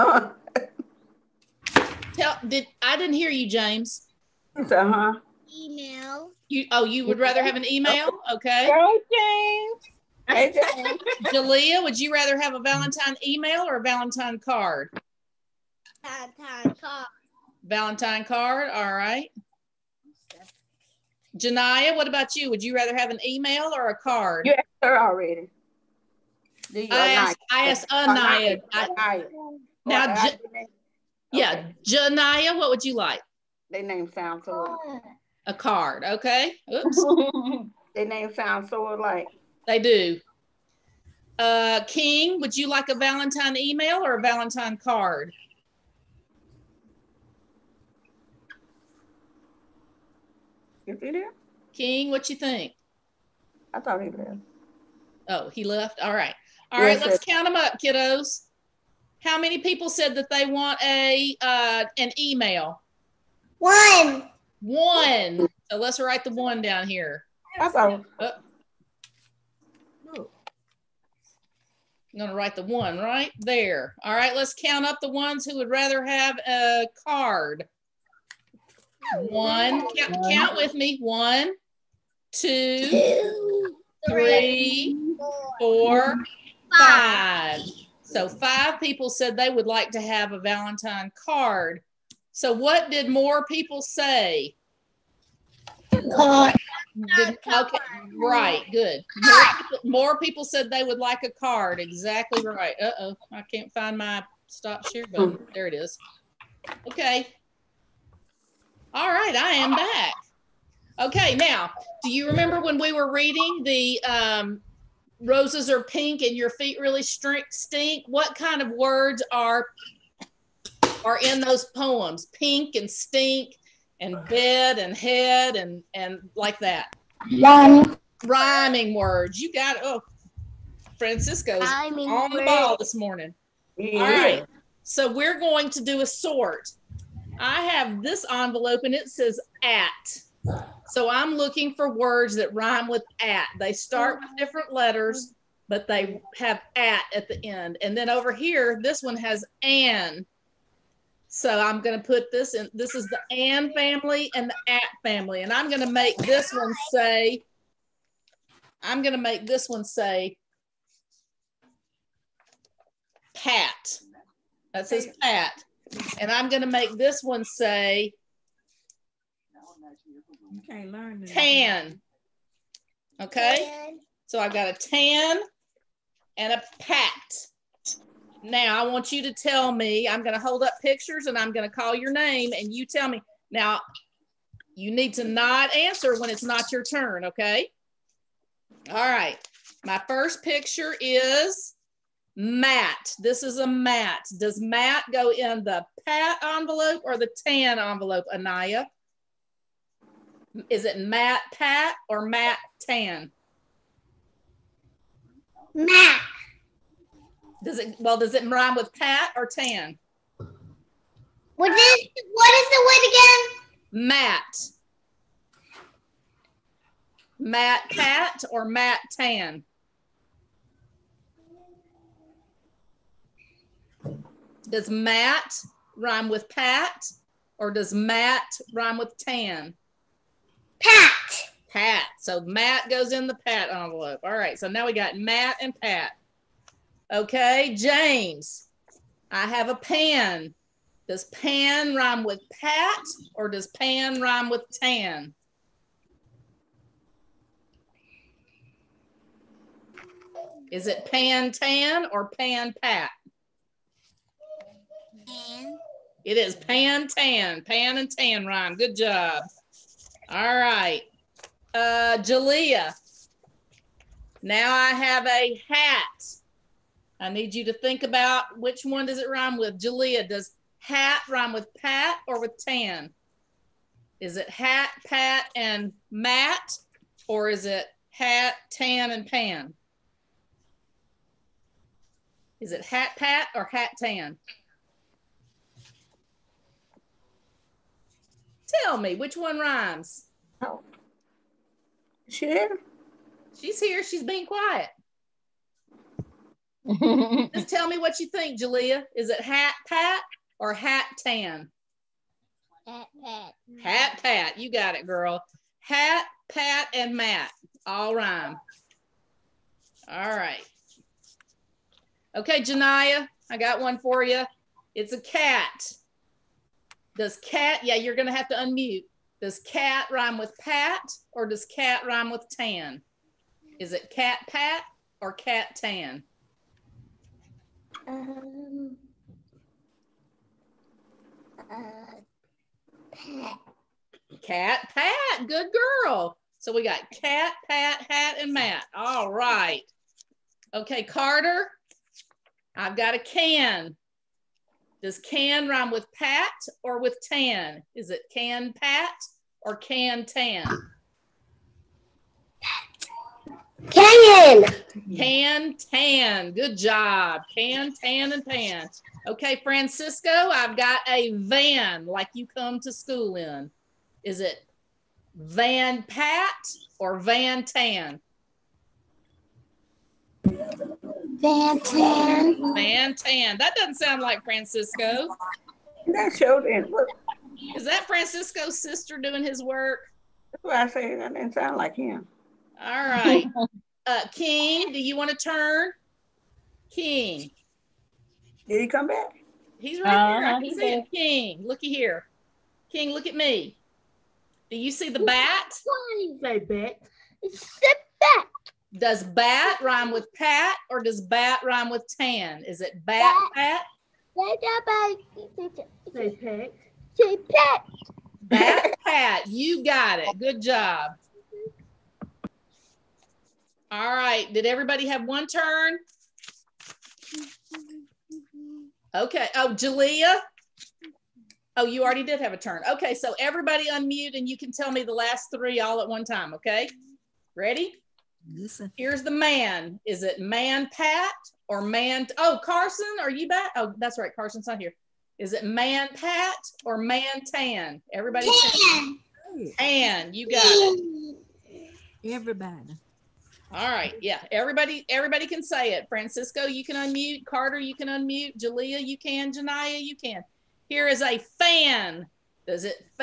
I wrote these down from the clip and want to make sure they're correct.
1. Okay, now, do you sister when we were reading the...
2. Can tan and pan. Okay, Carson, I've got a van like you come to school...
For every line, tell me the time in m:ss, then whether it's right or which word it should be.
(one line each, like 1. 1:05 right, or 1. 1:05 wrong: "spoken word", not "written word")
1. 1:50 wrong: "remember", not "sister"
2. 5:57 wrong: "Francisco", not "Carson".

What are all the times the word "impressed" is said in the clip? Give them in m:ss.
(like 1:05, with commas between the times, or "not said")
not said.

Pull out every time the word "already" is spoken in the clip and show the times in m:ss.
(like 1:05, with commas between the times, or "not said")
0:24, 7:02.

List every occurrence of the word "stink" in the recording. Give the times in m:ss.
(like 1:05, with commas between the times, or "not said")
1:57, 2:02.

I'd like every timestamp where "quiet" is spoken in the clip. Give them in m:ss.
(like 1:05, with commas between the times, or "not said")
4:54.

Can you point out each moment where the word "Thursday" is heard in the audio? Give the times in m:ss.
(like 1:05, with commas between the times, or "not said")
not said.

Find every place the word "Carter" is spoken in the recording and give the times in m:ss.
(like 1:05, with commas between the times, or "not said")
5:41, 7:27.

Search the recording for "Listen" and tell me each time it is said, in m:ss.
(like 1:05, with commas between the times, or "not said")
7:08.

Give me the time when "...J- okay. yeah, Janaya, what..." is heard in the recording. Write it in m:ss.
0:30.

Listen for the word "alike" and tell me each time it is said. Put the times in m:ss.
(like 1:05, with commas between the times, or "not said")
0:38.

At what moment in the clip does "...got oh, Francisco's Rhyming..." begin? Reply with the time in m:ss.
2:09.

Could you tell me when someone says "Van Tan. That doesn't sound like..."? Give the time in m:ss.
6:12.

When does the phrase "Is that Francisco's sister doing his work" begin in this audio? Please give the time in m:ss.
6:17.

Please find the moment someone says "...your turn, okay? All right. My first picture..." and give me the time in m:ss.
3:06.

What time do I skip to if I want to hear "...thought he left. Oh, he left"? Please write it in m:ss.
0:53.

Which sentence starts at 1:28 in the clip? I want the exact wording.
So five people said they would like to have a Valentine card.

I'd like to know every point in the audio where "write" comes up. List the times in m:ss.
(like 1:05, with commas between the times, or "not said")
1:05, 1:12.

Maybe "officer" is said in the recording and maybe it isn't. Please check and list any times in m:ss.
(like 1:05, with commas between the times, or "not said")
not said.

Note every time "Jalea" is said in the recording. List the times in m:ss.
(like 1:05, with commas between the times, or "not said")
0:11, 4:22, 4:29, 4:58, 6:59, 7:28.